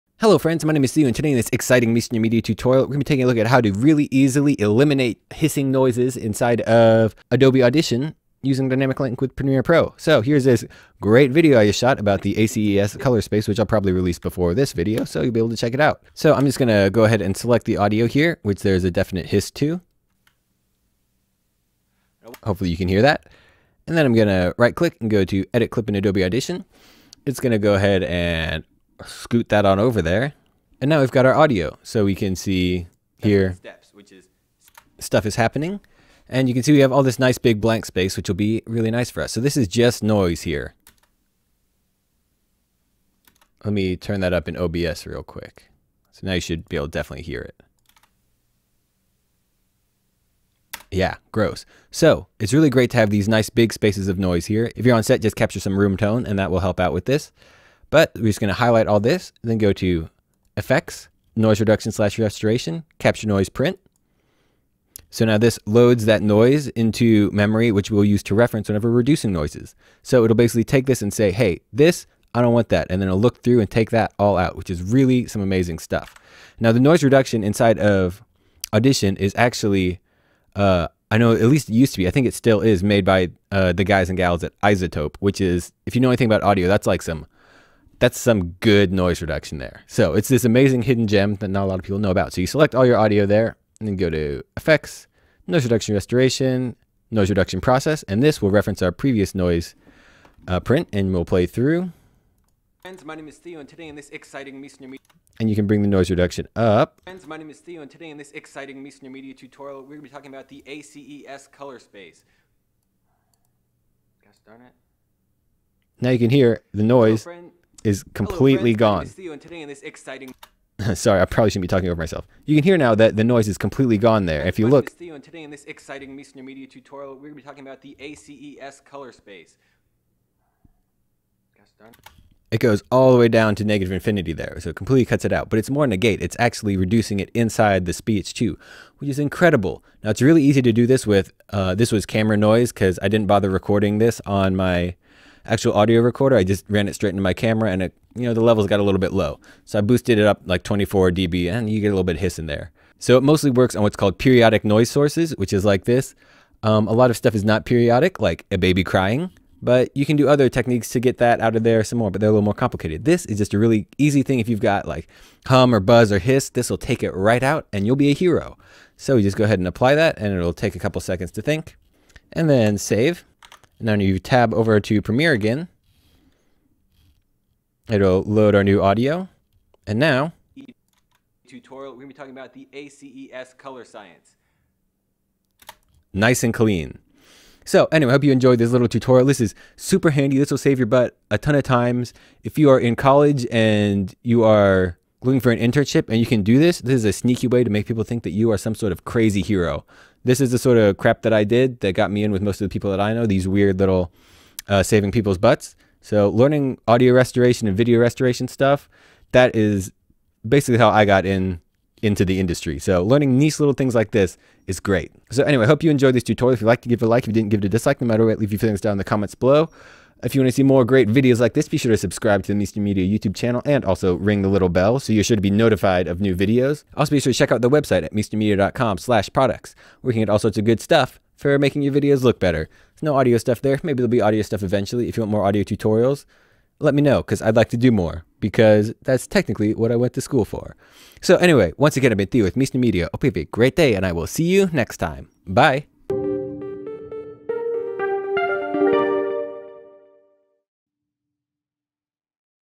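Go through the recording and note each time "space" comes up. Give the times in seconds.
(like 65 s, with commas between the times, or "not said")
13 s, 37 s, 53 s, 111 s, 129 s.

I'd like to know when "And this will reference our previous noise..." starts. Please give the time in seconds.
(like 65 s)
98 s.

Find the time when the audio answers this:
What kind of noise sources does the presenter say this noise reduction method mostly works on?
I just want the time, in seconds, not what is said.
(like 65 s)
154 s.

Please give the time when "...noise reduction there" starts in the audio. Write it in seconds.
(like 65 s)
88 s.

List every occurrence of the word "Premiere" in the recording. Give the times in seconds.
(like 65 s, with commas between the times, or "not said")
9 s, 175 s.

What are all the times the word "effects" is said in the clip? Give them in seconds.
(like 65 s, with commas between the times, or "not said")
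60 s, 94 s.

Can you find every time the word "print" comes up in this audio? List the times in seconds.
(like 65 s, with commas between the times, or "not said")
63 s, 100 s.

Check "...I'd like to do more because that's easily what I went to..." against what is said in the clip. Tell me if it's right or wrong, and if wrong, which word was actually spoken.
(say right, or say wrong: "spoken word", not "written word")
wrong: "technically", not "easily".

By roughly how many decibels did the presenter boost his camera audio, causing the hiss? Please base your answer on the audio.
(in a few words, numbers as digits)
24 dB.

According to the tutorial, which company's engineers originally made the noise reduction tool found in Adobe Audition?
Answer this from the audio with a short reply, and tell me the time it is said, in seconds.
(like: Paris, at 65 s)
iZotope, at 84 s.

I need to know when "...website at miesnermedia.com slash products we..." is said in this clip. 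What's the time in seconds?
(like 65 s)
227 s.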